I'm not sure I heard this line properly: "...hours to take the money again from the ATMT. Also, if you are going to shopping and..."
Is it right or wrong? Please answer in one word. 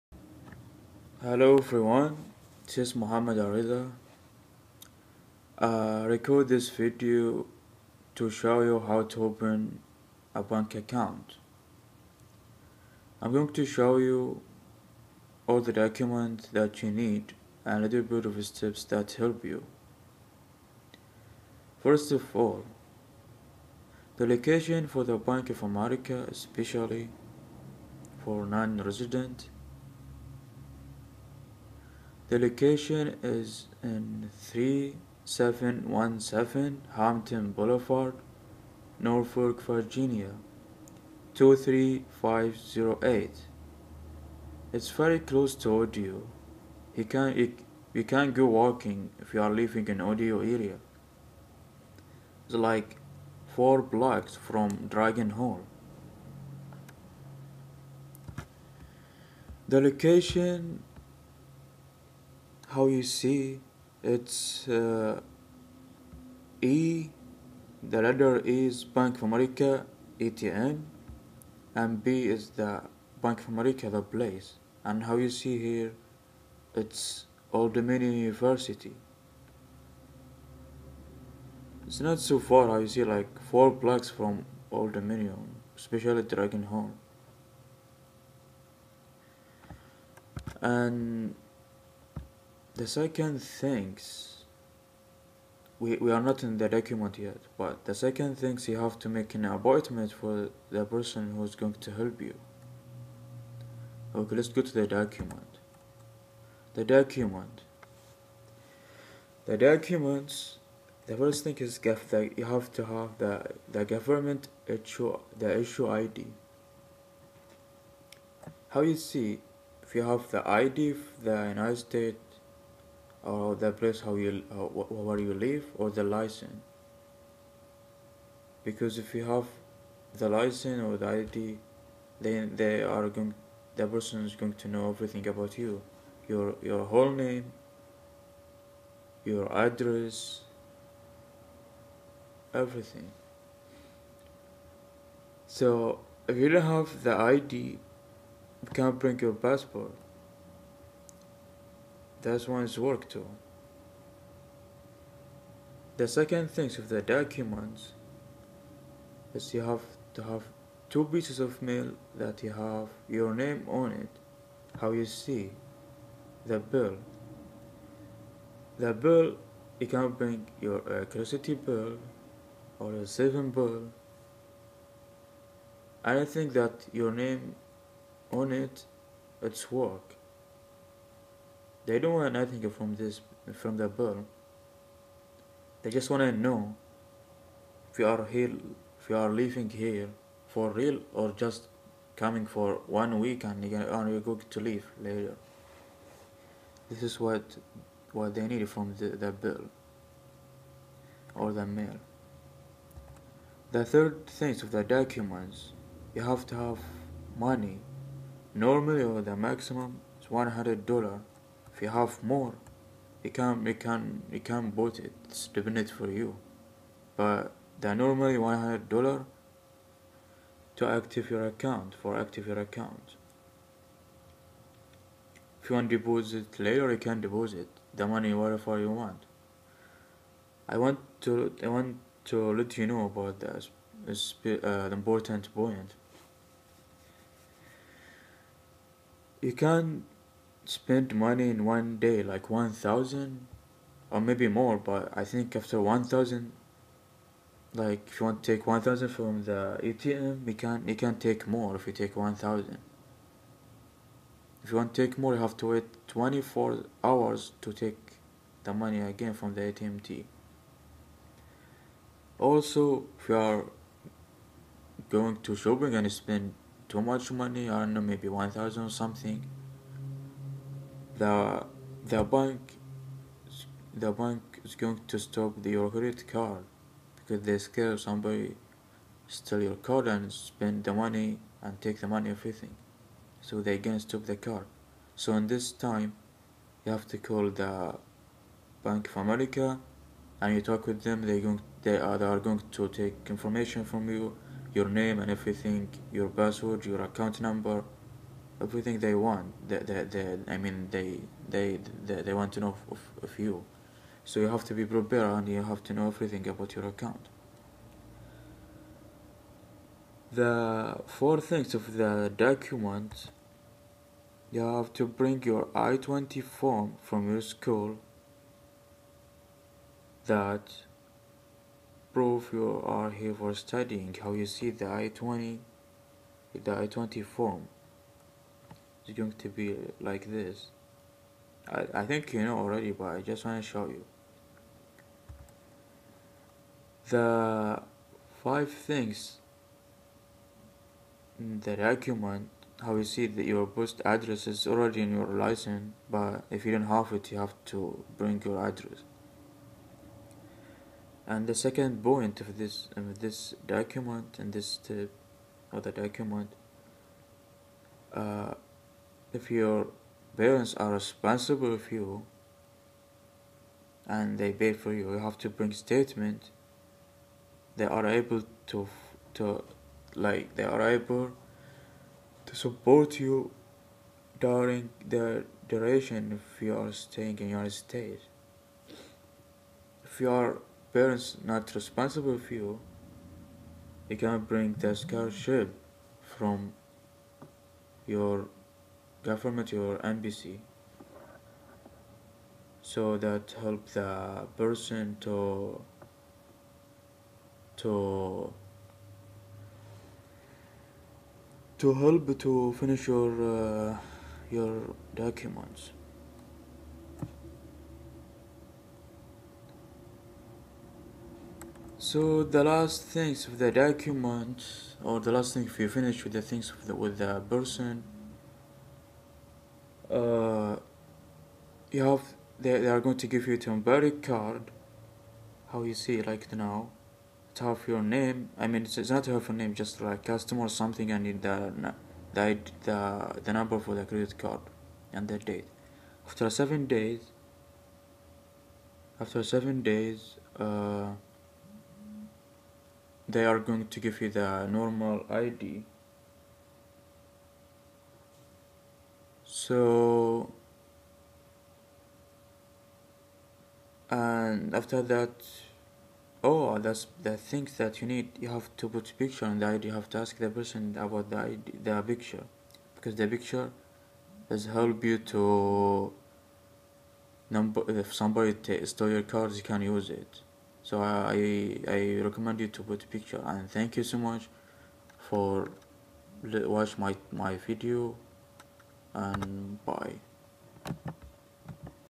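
right.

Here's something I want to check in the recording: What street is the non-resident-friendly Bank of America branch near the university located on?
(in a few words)
Hampton Boulevard.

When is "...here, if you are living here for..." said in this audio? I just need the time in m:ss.
3:08.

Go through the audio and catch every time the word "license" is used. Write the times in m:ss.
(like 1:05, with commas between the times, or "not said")
2:06, 2:10, 5:45.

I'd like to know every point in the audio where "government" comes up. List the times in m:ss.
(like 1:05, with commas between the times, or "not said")
1:53, 6:29.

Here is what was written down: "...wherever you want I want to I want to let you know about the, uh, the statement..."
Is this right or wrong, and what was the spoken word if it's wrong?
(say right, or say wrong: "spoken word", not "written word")
wrong: "important", not "statement".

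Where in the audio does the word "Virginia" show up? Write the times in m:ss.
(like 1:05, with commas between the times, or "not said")
0:39.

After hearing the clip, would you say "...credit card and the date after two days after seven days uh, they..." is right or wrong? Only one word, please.
wrong.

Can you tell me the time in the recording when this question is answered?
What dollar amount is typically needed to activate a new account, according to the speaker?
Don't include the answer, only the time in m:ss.
3:38.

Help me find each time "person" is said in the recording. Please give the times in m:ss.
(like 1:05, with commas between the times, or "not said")
1:40, 2:13, 6:34, 6:57, 7:40.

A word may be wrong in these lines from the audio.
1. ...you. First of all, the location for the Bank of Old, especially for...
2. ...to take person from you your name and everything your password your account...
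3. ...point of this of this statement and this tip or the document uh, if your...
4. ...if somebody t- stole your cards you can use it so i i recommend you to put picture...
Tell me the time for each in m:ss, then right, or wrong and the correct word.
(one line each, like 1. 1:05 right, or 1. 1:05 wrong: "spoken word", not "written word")
1. 0:19 wrong: "America", not "Old"
2. 4:52 wrong: "information", not "person"
3. 5:52 wrong: "document", not "statement"
4. 7:47 right.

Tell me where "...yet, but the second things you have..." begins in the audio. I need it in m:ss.
1:37.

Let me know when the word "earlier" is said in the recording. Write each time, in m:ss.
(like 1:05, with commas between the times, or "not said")
not said.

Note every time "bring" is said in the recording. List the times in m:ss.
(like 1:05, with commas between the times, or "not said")
2:28, 2:50, 5:15, 5:48, 6:05, 6:24.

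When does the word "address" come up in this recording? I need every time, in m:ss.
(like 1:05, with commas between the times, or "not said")
2:19, 5:44, 5:48.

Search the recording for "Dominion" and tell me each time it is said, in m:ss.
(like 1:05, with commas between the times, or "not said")
1:17, 1:24.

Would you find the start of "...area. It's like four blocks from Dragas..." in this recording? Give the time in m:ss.
0:50.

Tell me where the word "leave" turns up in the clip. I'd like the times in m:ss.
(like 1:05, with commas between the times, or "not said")
3:14.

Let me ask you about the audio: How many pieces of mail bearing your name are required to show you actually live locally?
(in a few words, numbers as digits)
2.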